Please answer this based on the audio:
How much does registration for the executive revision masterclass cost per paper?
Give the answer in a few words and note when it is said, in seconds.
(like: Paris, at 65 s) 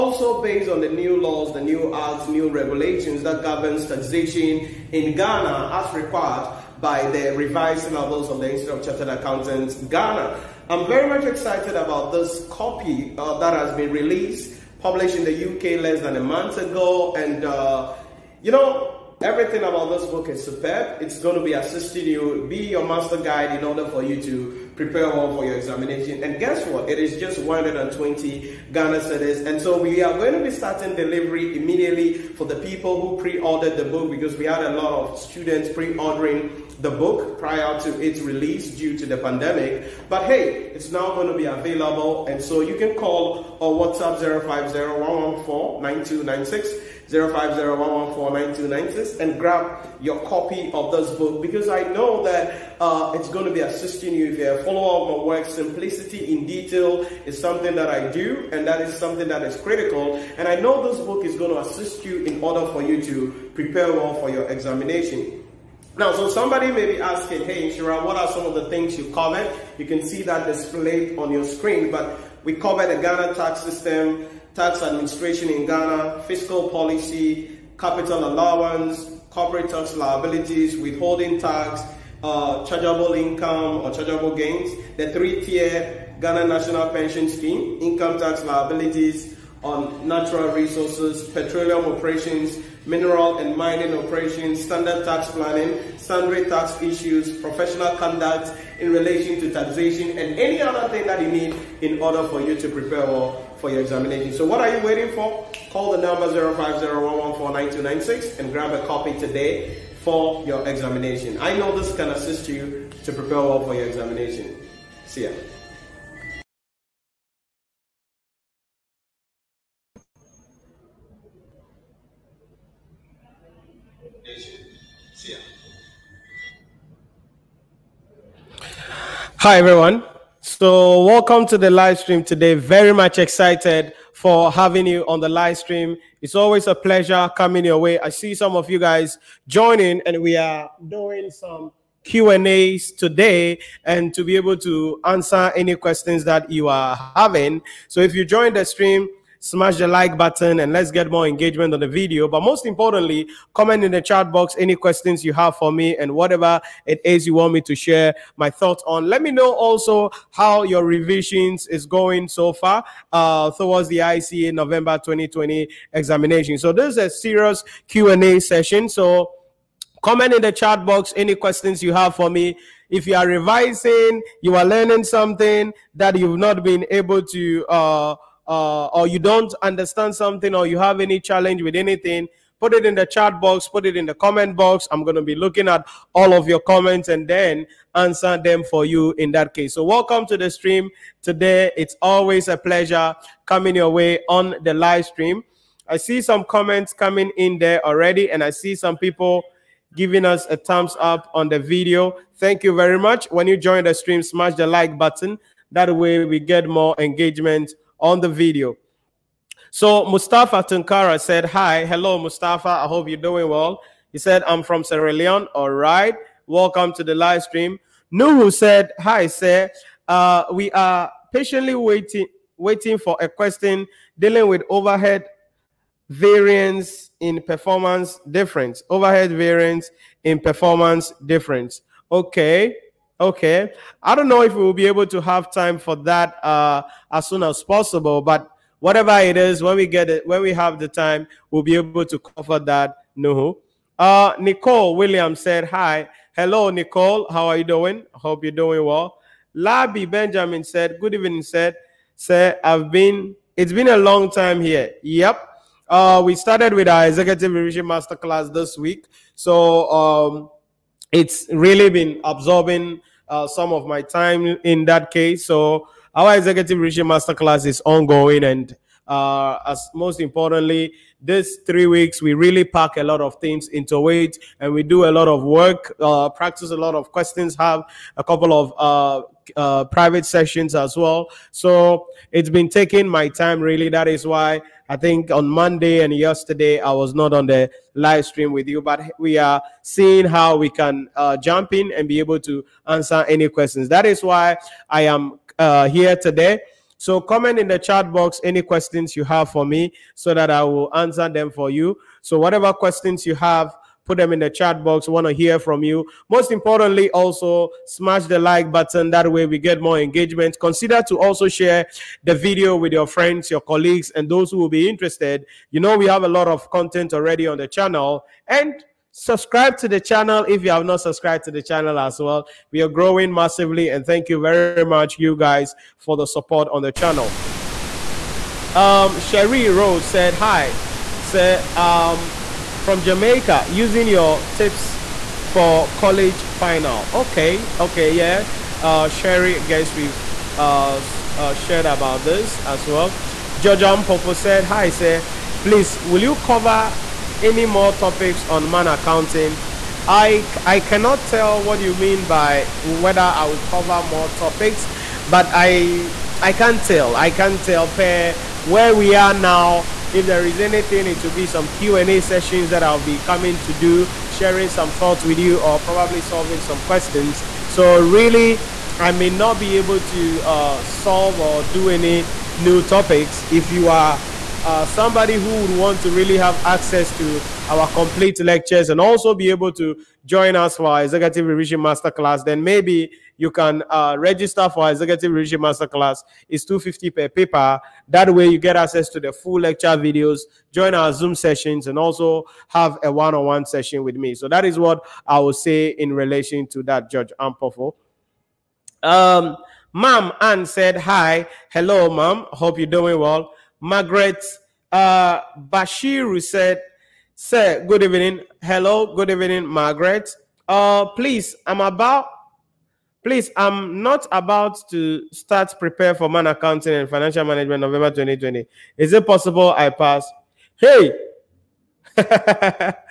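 250, at 386 s.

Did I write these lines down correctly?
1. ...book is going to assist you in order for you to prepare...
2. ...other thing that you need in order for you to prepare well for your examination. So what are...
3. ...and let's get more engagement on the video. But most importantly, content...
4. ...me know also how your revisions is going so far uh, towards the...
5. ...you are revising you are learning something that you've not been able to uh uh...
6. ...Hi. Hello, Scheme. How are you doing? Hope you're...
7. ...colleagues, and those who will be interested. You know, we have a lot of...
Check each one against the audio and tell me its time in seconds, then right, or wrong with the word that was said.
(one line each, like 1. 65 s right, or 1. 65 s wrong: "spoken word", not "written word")
1. 61 s right
2. 100 s right
3. 150 s wrong: "comment", not "content"
4. 159 s right
5. 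173 s right
6. 245 s wrong: "Nicole", not "Scheme"
7. 313 s right.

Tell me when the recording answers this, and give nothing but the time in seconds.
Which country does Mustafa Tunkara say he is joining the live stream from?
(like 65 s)
214 s.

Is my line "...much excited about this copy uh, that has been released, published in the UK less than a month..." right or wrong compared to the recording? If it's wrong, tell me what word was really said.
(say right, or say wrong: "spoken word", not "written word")
right.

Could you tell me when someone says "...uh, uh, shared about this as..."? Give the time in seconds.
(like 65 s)
340 s.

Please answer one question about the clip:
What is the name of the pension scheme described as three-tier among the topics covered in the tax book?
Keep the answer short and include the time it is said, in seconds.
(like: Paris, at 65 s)
Ghana National Pension Scheme, at 86 s.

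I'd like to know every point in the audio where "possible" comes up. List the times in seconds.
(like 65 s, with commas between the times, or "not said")
237 s, 419 s.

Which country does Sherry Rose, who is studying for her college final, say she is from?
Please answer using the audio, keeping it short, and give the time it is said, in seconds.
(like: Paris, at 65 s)
Jamaica, at 333 s.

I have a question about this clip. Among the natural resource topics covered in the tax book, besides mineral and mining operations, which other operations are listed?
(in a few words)
Petroleum operations.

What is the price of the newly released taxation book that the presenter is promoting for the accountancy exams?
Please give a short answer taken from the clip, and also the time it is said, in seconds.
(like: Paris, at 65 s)
120 Ghana cedis, at 27 s.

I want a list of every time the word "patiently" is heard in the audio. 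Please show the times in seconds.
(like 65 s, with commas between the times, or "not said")
221 s.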